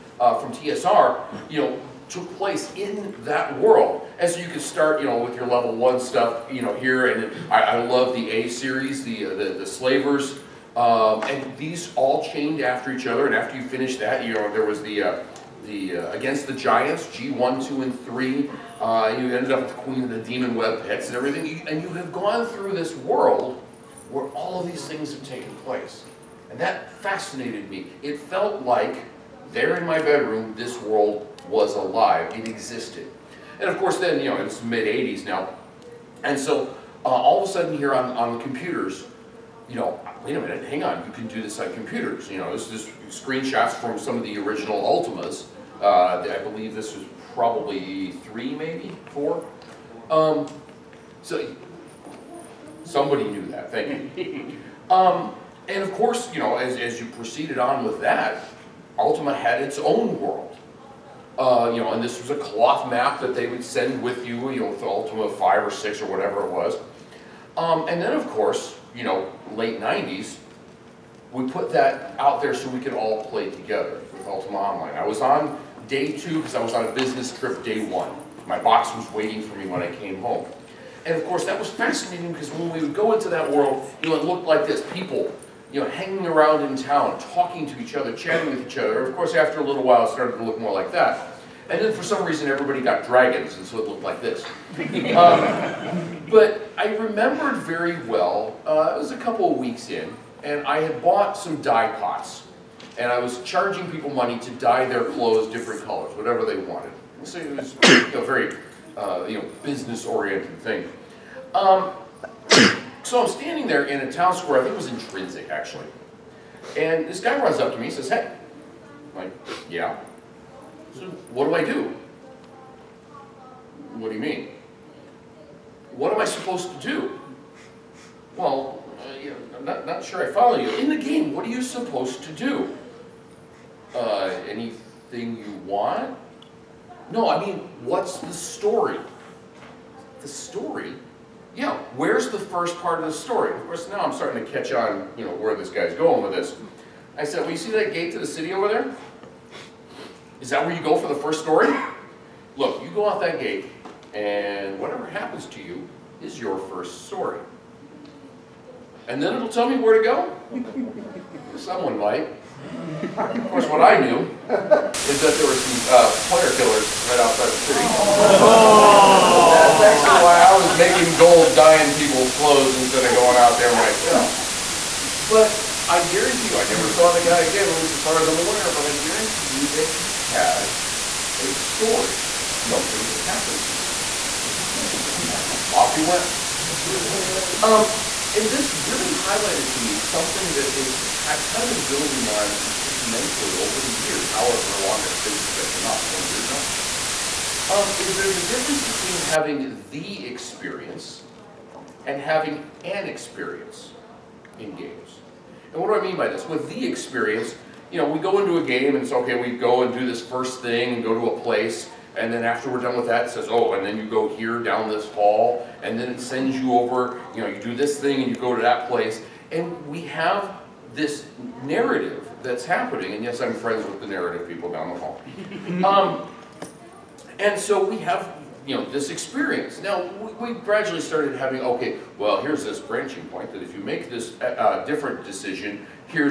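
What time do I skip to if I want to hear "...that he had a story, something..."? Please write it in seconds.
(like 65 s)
179 s.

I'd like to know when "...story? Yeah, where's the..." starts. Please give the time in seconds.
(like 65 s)
140 s.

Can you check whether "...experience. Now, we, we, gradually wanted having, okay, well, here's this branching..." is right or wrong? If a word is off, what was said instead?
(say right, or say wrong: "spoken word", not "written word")
wrong: "started", not "wanted".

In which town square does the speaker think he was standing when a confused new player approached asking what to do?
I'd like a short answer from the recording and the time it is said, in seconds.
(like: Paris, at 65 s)
Trinsic, at 114 s.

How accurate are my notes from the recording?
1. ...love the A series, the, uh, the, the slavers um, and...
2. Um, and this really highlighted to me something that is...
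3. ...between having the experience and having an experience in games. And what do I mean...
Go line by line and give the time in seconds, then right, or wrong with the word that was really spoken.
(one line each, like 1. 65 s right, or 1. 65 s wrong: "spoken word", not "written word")
1. 7 s right
2. 187 s right
3. 198 s right.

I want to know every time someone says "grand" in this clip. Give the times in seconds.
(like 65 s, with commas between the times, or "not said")
not said.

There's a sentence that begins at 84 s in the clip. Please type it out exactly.
People, you know, hanging around in town, talking to each other, chatting with each other.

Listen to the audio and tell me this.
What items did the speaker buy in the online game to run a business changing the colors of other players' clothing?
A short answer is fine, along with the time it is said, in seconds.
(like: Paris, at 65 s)
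Dye pots, at 101 s.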